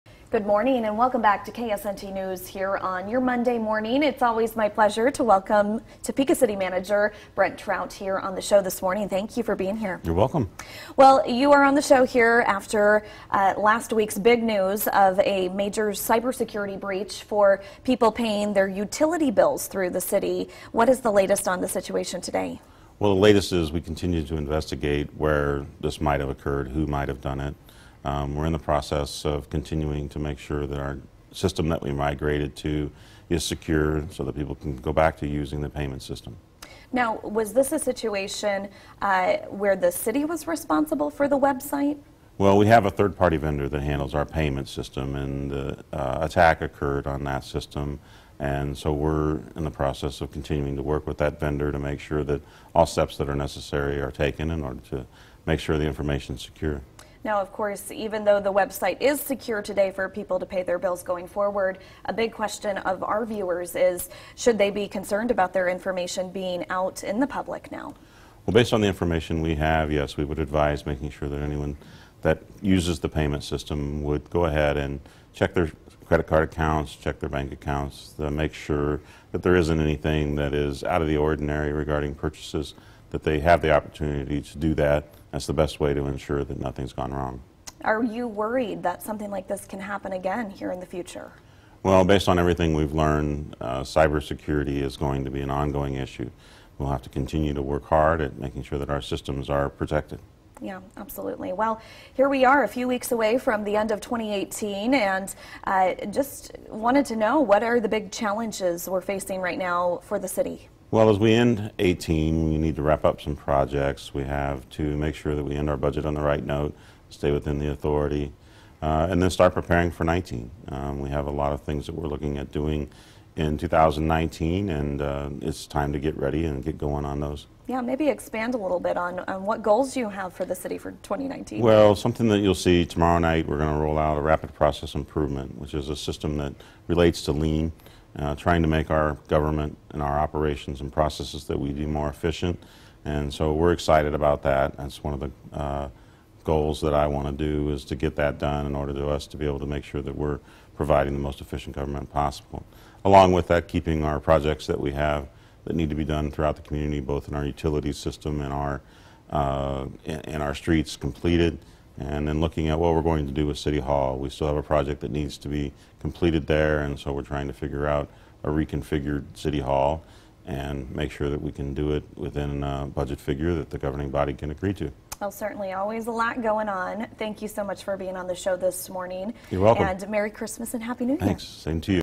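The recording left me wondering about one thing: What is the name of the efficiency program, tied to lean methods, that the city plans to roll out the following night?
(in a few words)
rapid process improvement.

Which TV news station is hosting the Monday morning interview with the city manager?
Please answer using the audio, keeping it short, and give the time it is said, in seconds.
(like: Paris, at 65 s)
KSNT News, at 1 s.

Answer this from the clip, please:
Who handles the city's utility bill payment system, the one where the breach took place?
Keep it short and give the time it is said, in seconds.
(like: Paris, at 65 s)
a third party vendor, at 42 s.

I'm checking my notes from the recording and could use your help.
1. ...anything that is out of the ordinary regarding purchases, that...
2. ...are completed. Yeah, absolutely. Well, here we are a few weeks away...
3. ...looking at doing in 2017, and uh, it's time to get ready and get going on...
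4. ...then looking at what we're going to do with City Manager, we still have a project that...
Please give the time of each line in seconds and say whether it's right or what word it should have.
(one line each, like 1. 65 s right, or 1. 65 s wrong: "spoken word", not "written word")
1. 79 s right
2. 99 s wrong: "protected", not "completed"
3. 122 s wrong: "2019", not "2017"
4. 162 s wrong: "Hall", not "Manager".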